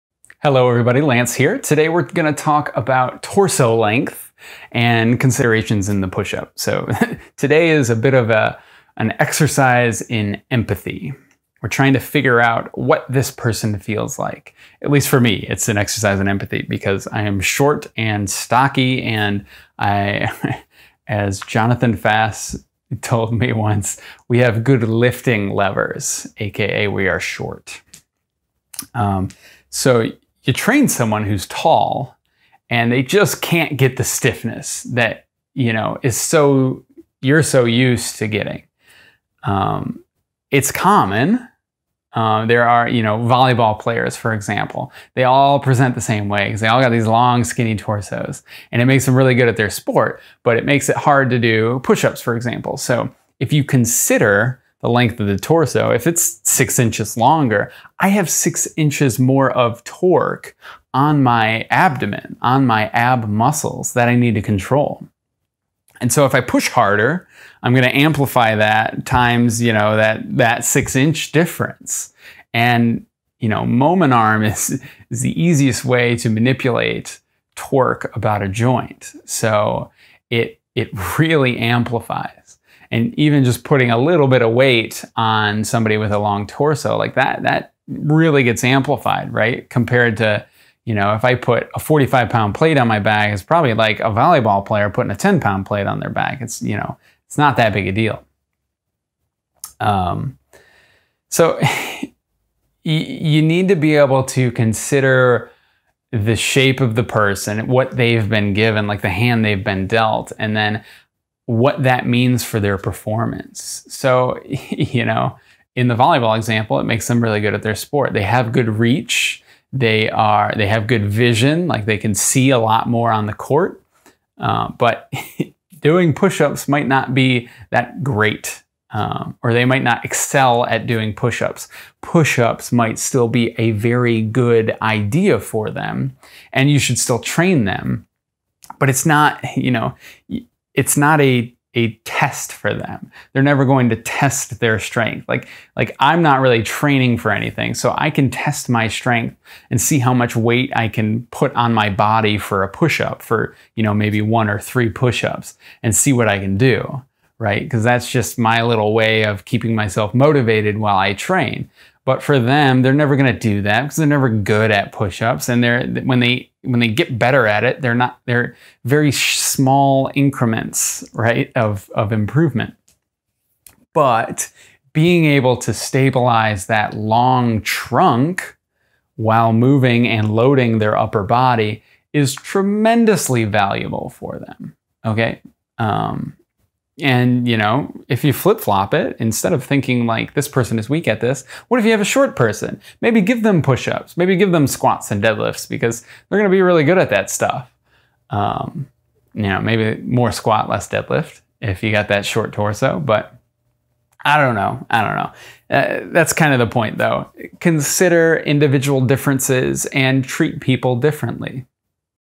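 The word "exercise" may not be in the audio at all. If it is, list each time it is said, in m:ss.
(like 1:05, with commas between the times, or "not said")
0:09, 0:15.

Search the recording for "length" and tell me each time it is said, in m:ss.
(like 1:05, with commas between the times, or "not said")
0:03, 0:54.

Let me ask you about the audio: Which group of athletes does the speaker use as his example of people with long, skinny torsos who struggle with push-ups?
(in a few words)
volleyball players.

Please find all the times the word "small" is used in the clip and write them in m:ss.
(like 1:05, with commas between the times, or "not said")
2:49.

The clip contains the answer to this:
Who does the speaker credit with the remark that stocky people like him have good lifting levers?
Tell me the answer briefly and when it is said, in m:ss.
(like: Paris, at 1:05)
Jonathan Fass, at 0:21.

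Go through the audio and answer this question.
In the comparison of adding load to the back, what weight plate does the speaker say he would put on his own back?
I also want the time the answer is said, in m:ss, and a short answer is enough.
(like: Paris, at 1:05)
45 pounds, at 1:31.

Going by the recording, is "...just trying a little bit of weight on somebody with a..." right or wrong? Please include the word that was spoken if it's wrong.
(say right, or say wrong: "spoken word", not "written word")
wrong: "putting", not "trying".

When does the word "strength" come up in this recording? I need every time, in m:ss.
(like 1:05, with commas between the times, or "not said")
2:24, 2:28.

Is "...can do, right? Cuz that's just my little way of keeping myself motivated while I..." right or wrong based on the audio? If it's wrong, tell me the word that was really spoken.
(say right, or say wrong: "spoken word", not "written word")
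right.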